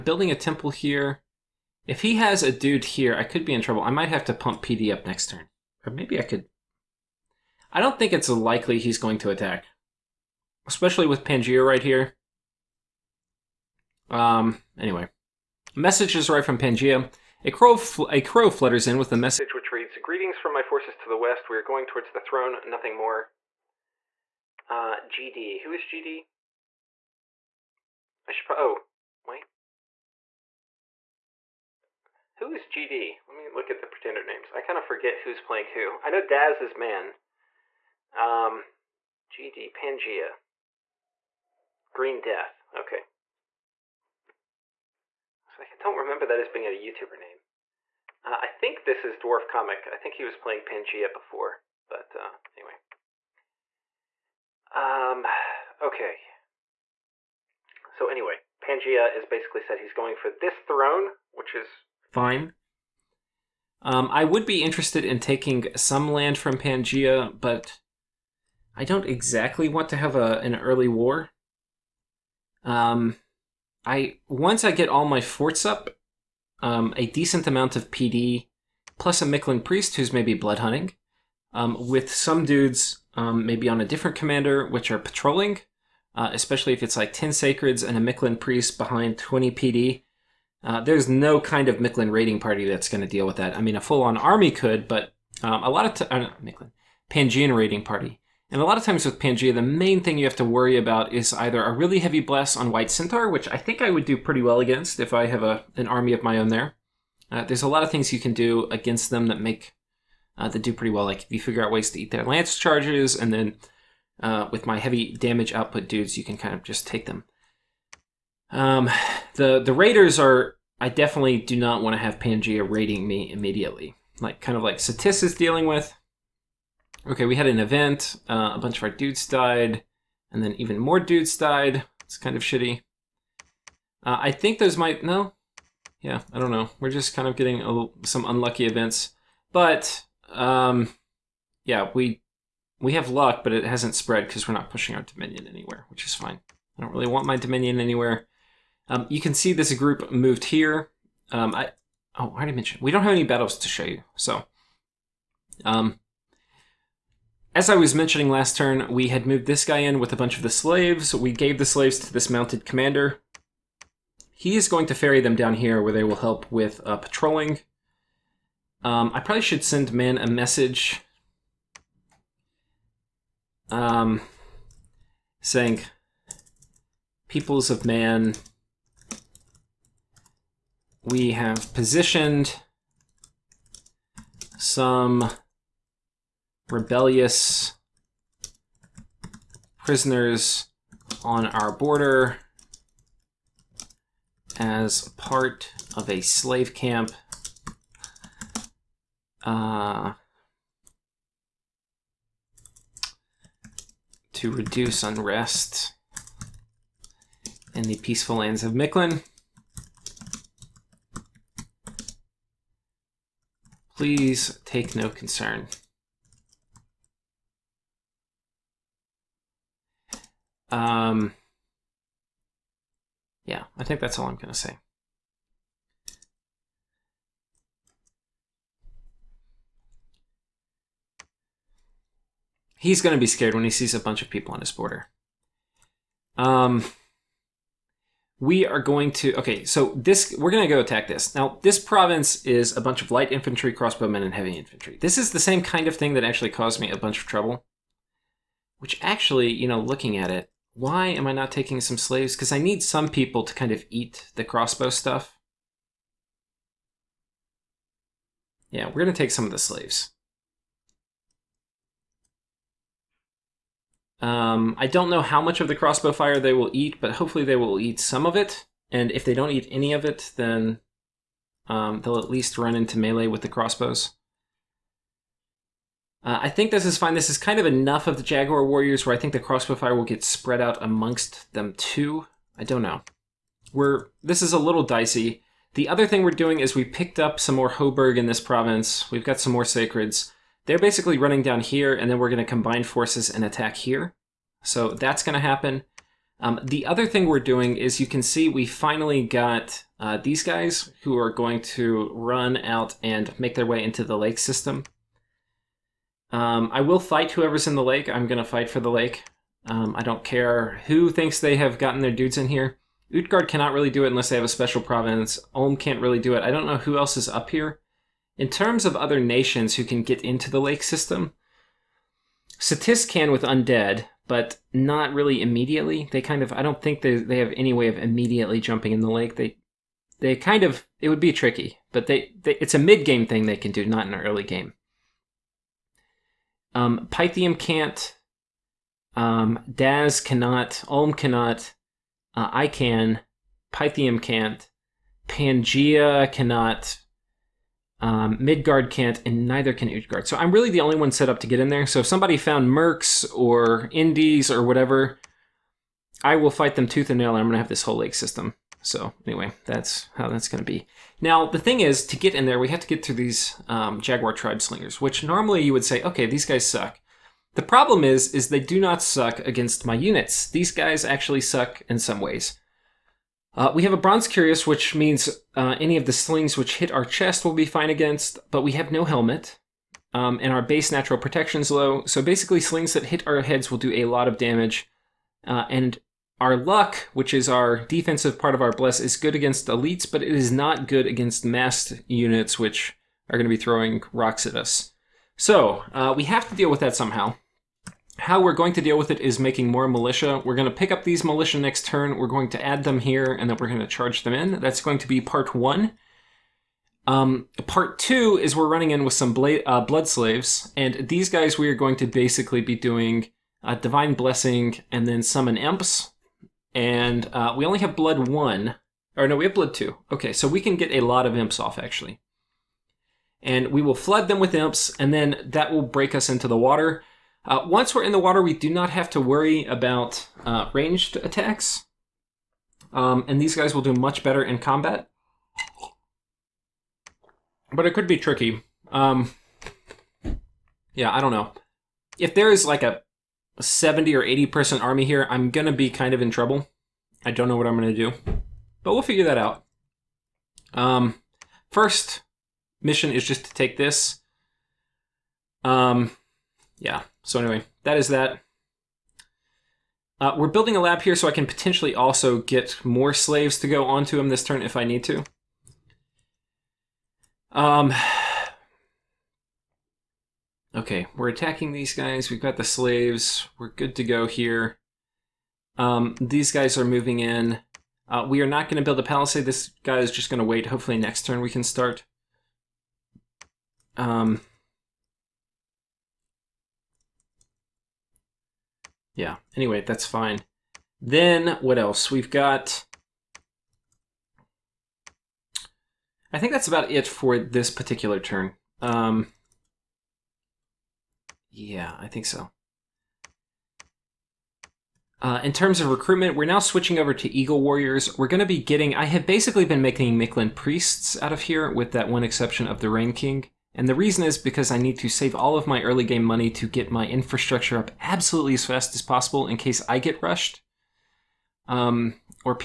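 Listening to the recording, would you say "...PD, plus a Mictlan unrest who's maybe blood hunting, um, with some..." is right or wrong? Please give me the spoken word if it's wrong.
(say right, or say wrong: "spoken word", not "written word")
wrong: "priest", not "unrest".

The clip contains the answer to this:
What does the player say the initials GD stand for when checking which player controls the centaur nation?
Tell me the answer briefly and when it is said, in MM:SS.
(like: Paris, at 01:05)
Green Death, at 00:41.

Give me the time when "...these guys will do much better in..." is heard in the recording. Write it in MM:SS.
07:13.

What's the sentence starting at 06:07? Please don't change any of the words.
The problem is, is they do not suck against my units.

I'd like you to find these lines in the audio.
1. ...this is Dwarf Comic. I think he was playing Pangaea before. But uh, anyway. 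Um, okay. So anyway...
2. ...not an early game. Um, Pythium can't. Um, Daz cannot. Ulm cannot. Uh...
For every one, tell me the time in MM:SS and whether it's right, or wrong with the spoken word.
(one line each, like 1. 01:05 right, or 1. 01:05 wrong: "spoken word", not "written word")
1. 00:48 right
2. 05:33 right.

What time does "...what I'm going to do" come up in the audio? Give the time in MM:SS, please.
07:27.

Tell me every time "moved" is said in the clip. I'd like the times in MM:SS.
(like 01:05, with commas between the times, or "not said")
02:30, 02:39.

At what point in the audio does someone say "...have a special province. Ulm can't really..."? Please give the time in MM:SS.
05:14.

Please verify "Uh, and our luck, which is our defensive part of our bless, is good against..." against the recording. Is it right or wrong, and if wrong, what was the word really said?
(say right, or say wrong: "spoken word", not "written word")
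right.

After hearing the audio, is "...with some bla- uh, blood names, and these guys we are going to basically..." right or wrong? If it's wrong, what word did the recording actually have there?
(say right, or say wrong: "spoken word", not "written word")
wrong: "slaves", not "names".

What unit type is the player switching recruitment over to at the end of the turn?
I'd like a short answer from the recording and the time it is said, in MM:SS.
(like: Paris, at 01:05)
Eagle Warriors, at 08:27.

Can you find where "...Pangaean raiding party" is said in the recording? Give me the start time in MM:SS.
01:37.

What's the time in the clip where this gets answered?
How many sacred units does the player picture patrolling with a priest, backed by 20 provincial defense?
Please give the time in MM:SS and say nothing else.
01:27.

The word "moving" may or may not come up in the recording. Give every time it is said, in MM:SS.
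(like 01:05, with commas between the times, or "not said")
07:56.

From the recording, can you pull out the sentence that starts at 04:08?
Which actually, you know, looking at it, why am I not taking some slaves?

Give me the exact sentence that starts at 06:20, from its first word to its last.
Um, and our base natural protection is low.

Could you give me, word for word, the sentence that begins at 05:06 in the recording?
Um, I will fight whoever's in the lake.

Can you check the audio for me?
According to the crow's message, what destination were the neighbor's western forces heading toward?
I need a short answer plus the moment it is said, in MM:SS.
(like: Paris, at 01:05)
the throne, at 00:21.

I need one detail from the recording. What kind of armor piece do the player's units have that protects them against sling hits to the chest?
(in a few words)
Bronze Cuirass.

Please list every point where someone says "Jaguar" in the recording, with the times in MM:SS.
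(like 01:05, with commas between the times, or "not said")
04:38, 06:04.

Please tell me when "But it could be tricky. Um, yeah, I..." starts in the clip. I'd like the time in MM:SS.
07:17.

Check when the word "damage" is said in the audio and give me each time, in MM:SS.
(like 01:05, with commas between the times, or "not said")
01:55, 06:24.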